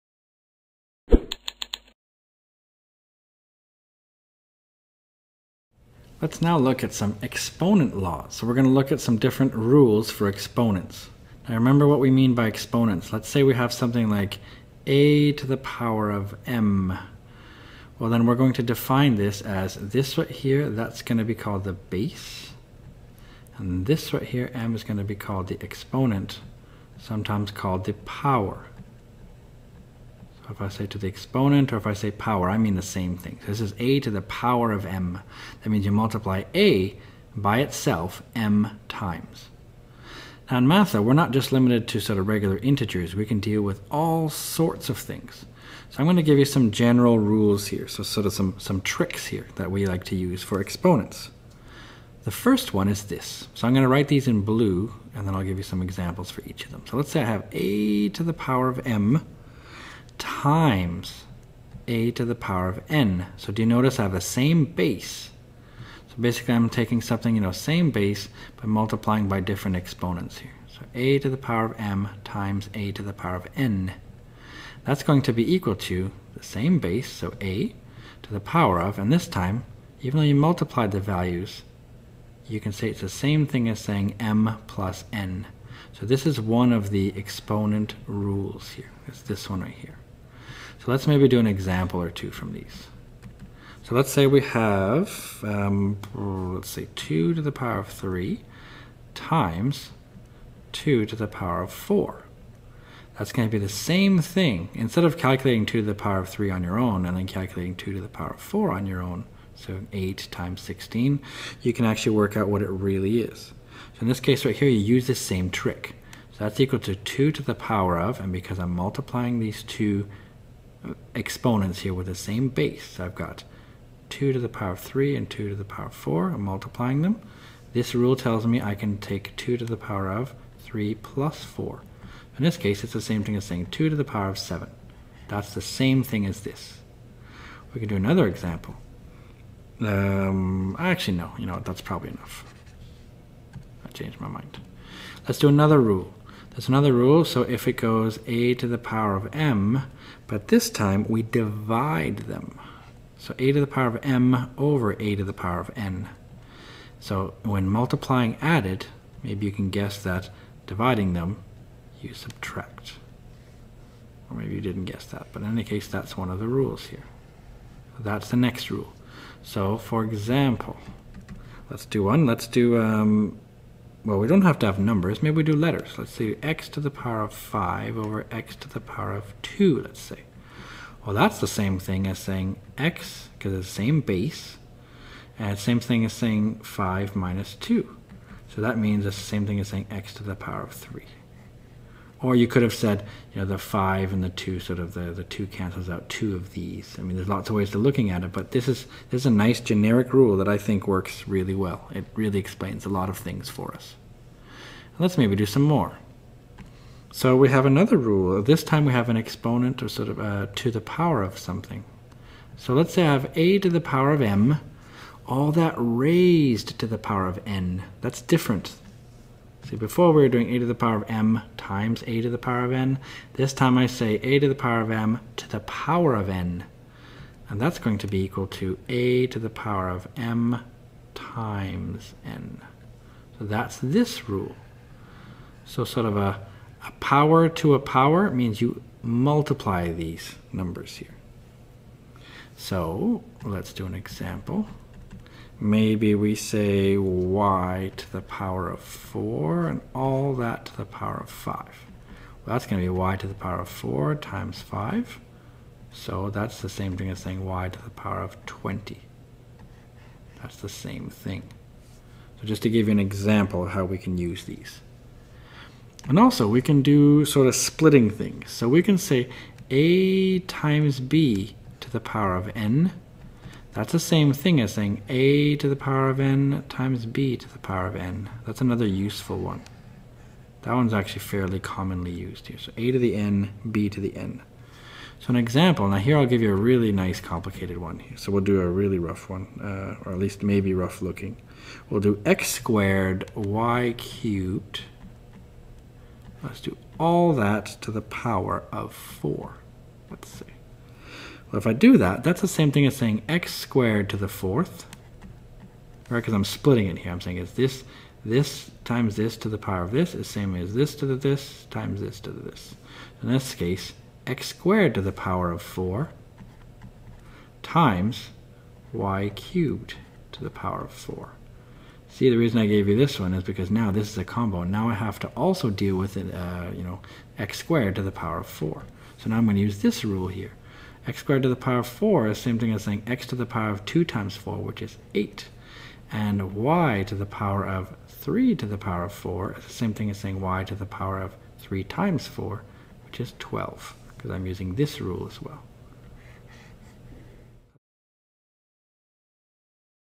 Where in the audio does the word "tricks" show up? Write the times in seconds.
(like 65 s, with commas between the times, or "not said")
48 s, 115 s.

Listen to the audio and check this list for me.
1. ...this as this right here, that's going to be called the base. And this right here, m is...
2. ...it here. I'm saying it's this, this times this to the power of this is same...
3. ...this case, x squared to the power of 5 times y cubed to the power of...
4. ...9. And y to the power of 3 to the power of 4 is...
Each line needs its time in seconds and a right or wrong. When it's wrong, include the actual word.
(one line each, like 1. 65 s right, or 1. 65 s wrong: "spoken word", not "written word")
1. 19 s right
2. 306 s right
3. 313 s wrong: "4", not "5"
4. 335 s wrong: "8", not "9".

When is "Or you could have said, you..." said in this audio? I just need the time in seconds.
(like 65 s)
192 s.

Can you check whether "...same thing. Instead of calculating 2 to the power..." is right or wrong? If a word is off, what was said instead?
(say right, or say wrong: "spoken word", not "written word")
right.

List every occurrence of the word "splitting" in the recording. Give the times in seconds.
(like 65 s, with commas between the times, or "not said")
267 s, 306 s.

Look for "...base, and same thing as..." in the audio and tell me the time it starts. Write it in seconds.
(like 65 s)
184 s.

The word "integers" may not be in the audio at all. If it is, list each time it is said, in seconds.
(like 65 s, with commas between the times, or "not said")
42 s.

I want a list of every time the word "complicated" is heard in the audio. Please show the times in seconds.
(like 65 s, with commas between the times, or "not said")
287 s.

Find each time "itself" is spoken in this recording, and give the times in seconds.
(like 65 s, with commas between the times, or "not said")
37 s.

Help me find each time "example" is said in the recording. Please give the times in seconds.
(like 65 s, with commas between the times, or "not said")
55 s, 91 s, 138 s, 170 s, 243 s, 262 s, 285 s.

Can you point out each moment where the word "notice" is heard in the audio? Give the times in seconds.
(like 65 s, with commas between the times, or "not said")
63 s.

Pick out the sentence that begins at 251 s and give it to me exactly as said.
Well, that's going to be y to the power of 4 times 5.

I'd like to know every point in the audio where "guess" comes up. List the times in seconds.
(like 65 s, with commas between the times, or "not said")
159 s, 164 s.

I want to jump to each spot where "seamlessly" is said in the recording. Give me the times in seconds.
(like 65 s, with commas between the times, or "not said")
not said.